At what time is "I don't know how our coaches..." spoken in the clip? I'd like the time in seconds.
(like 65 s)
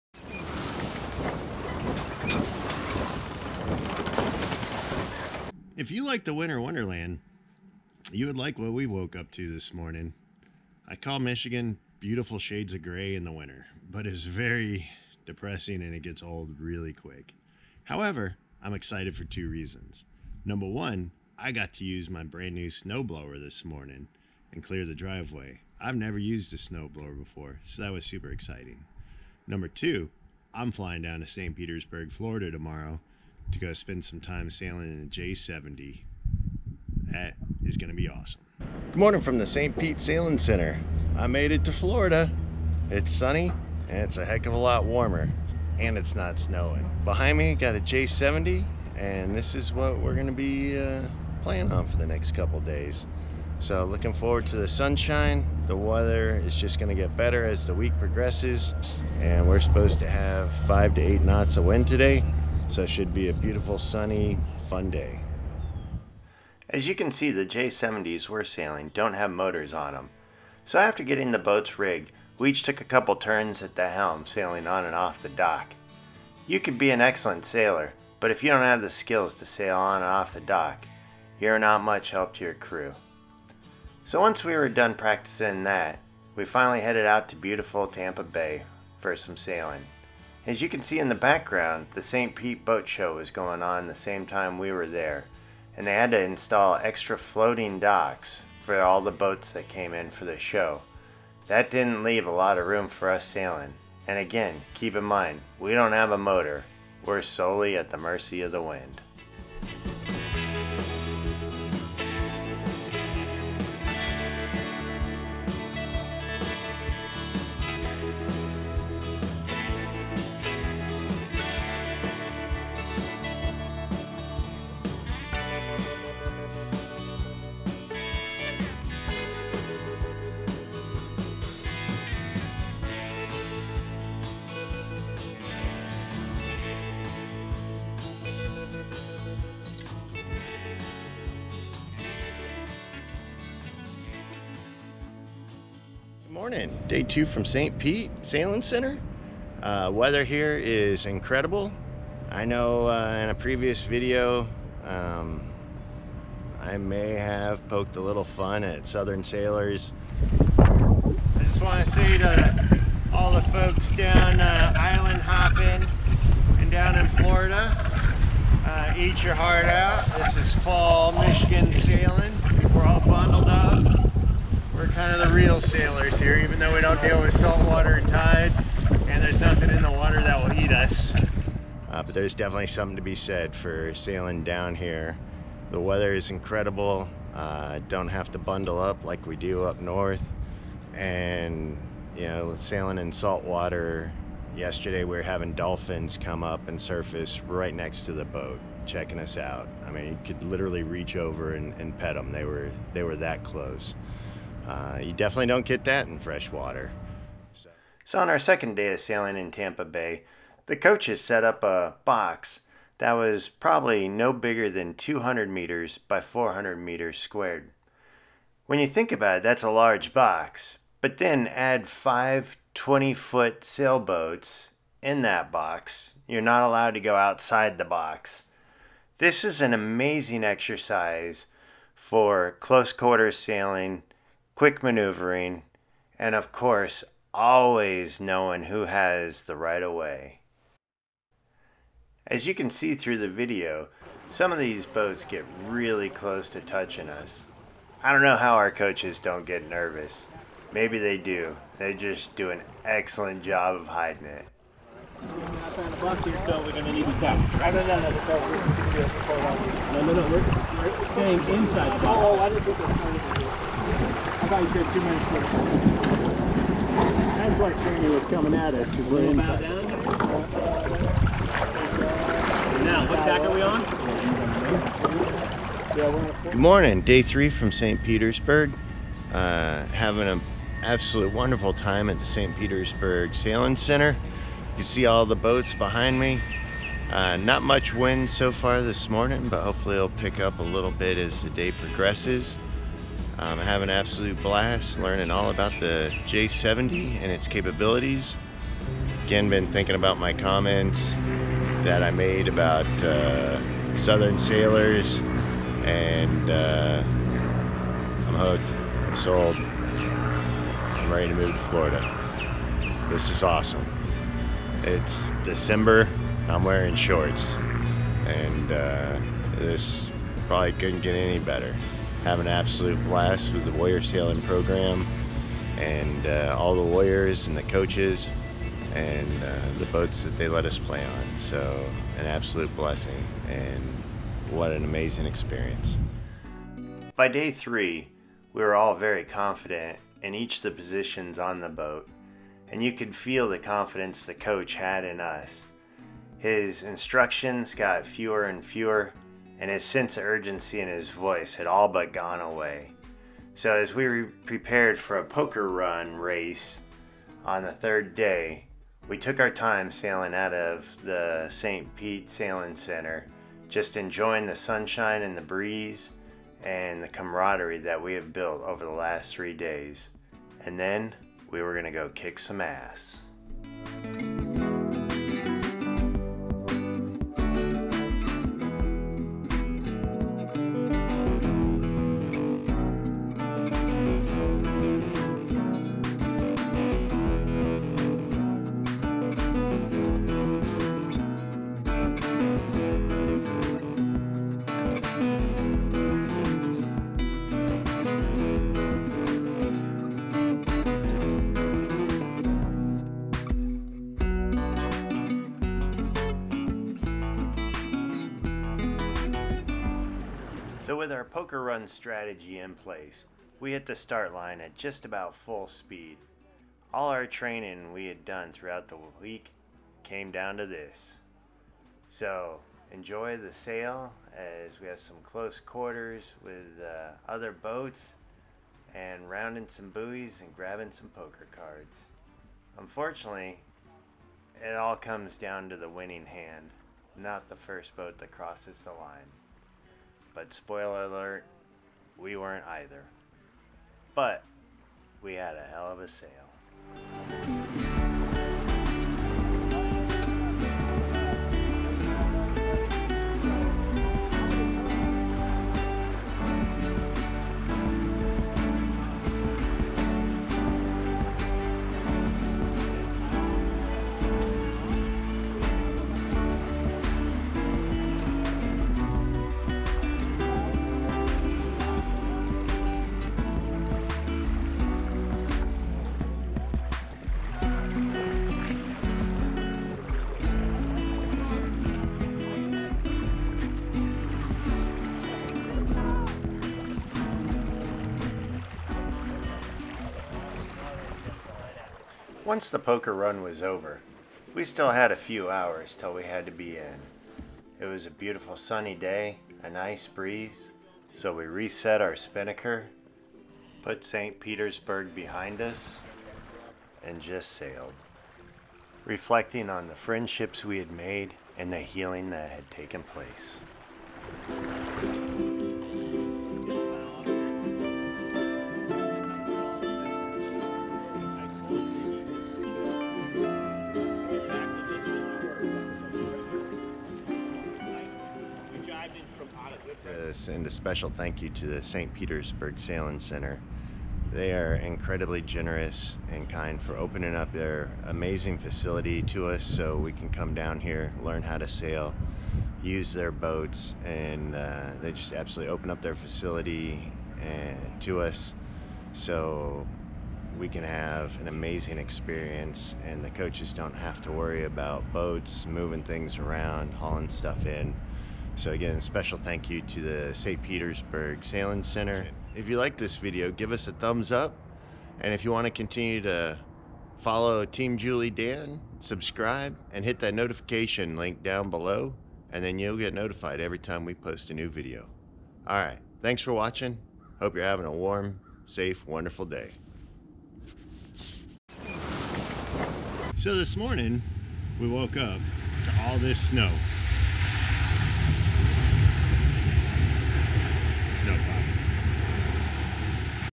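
248 s.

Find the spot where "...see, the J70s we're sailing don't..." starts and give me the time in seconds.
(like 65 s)
67 s.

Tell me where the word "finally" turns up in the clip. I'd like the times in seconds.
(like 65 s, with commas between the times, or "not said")
86 s.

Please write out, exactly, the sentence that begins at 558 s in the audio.
So again, special thank you to the St.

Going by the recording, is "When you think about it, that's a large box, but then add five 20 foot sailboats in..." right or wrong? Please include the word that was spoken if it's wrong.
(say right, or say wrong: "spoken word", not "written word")
right.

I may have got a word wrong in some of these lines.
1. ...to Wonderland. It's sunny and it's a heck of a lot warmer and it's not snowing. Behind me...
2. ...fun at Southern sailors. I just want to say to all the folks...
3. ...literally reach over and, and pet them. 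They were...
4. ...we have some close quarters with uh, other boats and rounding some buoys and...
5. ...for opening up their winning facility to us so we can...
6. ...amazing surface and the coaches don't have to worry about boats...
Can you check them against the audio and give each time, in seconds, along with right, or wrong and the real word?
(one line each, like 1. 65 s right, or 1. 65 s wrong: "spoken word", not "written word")
1. 41 s wrong: "Florida", not "Wonderland"
2. 158 s right
3. 200 s right
4. 424 s right
5. 536 s wrong: "amazing", not "winning"
6. 551 s wrong: "experience", not "surface".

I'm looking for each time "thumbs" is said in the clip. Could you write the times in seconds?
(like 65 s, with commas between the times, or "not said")
563 s.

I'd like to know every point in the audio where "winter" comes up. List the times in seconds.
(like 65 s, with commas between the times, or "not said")
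6 s, 13 s.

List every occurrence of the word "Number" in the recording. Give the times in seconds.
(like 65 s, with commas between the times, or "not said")
20 s, 29 s.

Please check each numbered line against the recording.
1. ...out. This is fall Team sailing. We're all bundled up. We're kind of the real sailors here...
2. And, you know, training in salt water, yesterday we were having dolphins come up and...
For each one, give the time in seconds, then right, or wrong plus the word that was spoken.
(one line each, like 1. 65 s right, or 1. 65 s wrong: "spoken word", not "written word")
1. 169 s wrong: "Michigan", not "Team"
2. 190 s wrong: "sailing", not "training".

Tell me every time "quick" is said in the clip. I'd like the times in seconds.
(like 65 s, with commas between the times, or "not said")
16 s, 234 s.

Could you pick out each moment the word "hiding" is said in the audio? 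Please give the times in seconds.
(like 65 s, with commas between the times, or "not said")
253 s.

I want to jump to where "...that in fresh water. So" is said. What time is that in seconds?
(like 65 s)
205 s.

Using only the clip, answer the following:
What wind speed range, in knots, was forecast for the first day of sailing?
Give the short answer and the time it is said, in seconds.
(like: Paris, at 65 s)
5 to 8 knots, at 60 s.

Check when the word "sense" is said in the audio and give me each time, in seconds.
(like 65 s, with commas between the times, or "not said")
349 s.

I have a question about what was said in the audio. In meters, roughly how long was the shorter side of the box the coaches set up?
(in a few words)
200 meters.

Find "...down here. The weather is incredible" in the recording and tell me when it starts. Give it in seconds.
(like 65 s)
184 s.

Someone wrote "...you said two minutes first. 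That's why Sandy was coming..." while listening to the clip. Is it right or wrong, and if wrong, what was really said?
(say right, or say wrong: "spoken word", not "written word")
right.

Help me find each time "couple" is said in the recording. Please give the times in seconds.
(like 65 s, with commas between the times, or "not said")
52 s, 72 s.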